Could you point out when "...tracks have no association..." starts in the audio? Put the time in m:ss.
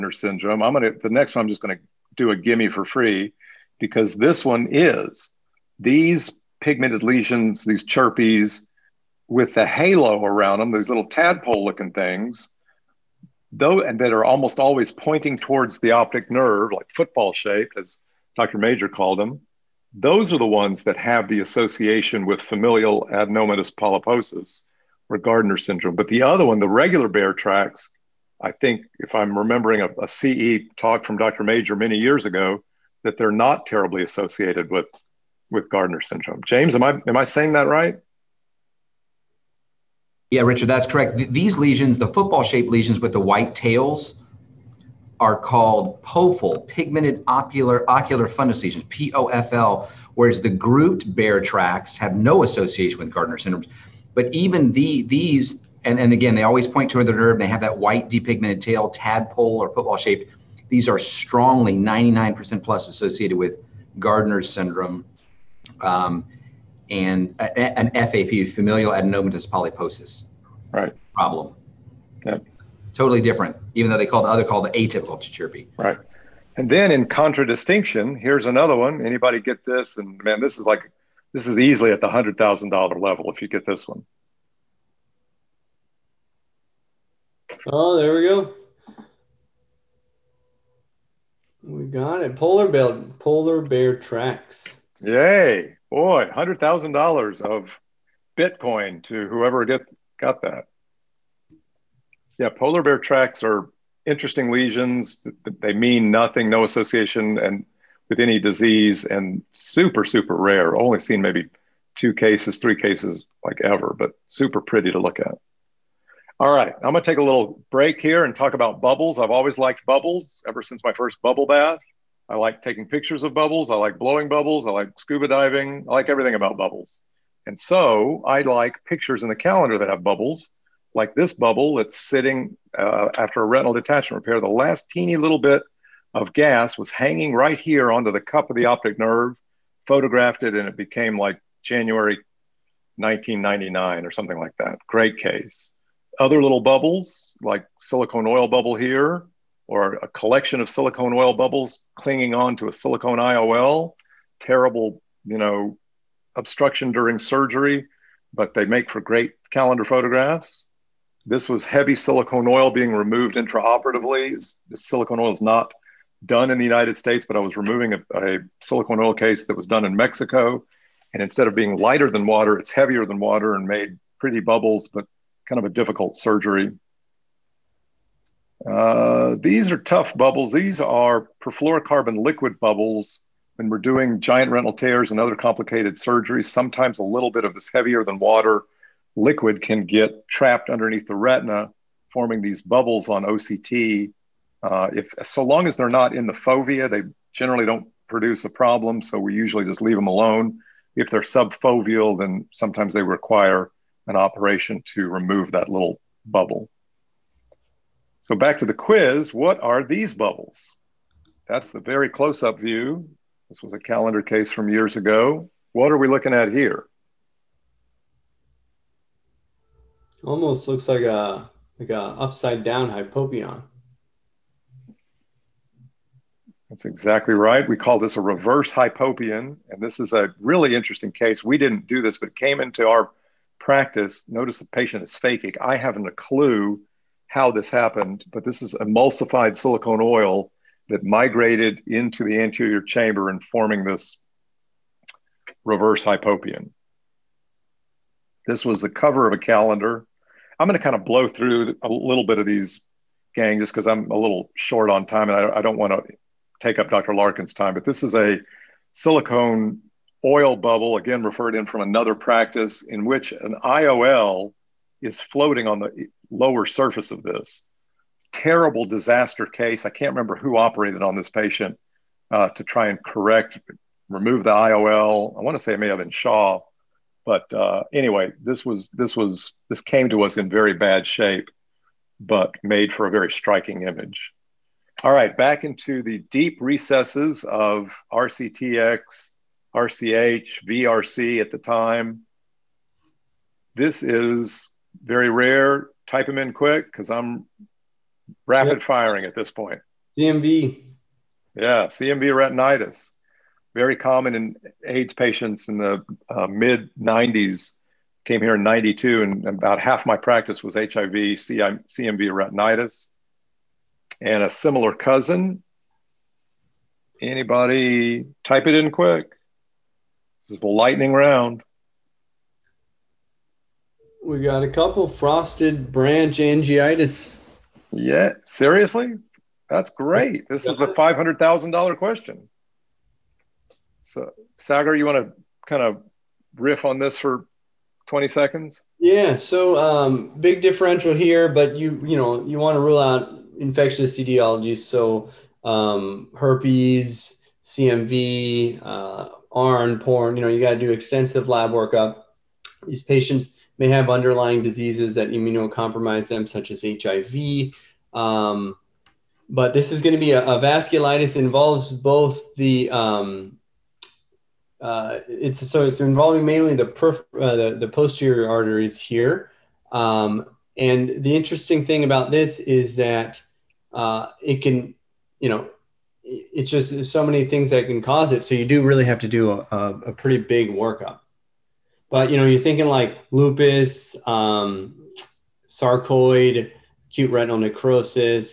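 0:51.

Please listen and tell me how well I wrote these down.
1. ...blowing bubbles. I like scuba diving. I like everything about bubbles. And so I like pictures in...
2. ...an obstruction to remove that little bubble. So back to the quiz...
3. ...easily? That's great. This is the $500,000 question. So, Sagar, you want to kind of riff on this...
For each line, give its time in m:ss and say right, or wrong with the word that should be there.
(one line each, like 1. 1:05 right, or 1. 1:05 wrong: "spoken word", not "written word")
1. 2:03 right
2. 3:24 wrong: "operation", not "obstruction"
3. 5:28 wrong: "seriously", not "easily".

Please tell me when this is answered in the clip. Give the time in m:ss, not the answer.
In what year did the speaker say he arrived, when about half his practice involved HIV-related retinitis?
5:08.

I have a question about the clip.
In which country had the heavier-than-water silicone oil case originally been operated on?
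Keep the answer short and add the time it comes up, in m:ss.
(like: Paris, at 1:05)
Mexico, at 2:49.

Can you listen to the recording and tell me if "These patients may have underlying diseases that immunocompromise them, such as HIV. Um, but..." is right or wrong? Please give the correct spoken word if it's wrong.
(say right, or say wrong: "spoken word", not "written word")
right.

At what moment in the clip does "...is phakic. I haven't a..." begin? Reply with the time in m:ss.
3:55.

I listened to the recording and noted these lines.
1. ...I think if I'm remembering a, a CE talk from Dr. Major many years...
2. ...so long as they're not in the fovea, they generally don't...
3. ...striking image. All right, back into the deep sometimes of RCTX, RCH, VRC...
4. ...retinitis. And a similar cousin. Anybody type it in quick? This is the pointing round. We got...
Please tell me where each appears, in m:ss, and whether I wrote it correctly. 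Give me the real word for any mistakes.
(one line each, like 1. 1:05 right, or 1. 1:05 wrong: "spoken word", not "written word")
1. 0:28 right
2. 3:15 right
3. 4:43 wrong: "recesses", not "sometimes"
4. 5:12 wrong: "lightning", not "pointing".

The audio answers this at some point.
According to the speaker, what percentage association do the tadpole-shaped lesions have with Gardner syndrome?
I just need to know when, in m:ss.
1:01.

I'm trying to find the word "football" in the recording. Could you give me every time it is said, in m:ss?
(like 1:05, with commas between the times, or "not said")
0:16, 0:42, 0:59.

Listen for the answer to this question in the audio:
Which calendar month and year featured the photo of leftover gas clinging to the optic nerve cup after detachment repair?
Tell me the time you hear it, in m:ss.
2:21.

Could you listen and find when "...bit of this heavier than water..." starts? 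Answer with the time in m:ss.
3:07.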